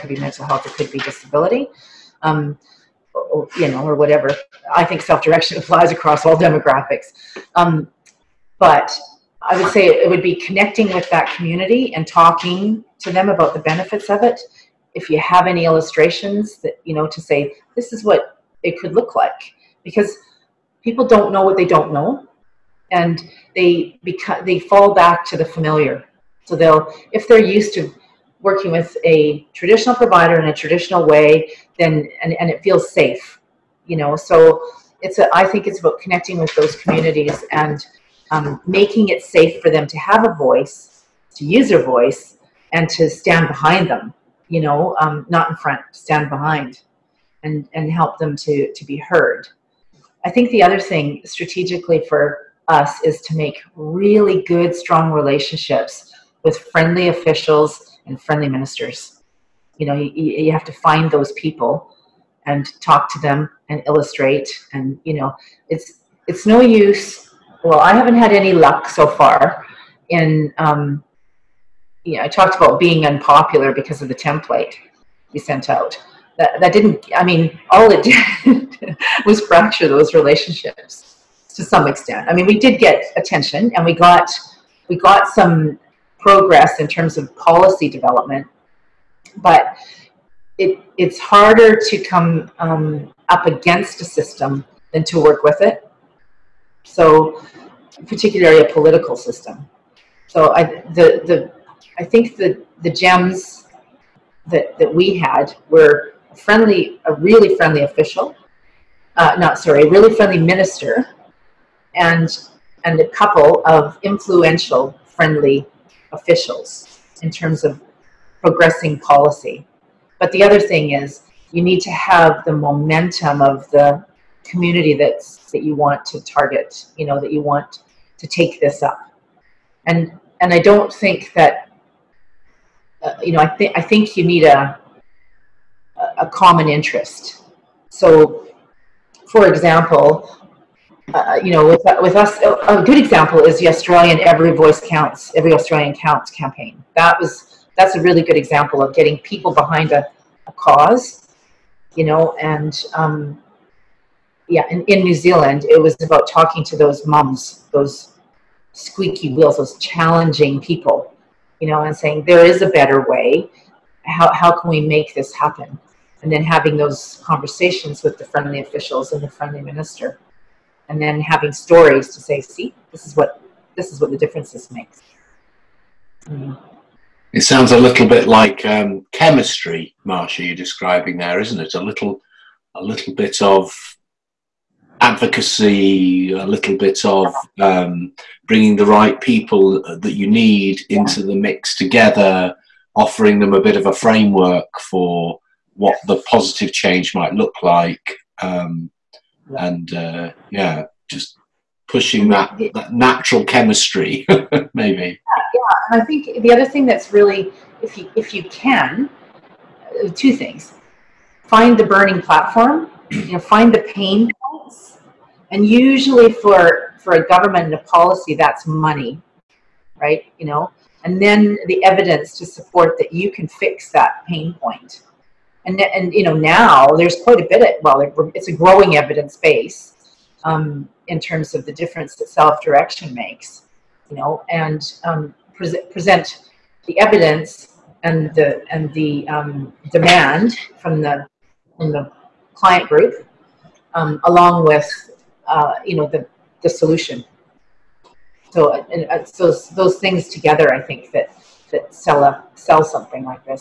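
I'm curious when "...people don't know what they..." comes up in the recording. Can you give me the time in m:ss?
0:20.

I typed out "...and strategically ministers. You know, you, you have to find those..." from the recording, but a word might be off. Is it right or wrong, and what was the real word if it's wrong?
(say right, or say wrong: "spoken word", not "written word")
wrong: "friendly", not "strategically".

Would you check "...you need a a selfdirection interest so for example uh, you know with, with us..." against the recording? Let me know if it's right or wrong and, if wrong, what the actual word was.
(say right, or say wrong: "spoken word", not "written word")
wrong: "common", not "selfdirection".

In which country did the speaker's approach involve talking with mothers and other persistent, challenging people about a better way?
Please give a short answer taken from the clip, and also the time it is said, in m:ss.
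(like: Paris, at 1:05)
New Zealand, at 2:35.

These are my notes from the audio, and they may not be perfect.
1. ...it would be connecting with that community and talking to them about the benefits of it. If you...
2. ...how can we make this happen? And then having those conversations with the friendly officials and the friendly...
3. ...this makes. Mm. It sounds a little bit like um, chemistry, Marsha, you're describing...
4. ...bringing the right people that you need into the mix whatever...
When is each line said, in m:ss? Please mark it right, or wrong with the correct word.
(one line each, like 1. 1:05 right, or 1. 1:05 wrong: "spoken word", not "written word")
1. 0:09 right
2. 2:44 right
3. 2:54 right
4. 3:08 wrong: "together", not "whatever".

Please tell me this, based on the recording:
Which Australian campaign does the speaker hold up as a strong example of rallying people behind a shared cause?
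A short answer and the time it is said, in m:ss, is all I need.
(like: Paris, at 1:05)
Every Australian Counts, at 2:25.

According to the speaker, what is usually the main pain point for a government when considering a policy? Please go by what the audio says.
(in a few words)
Money.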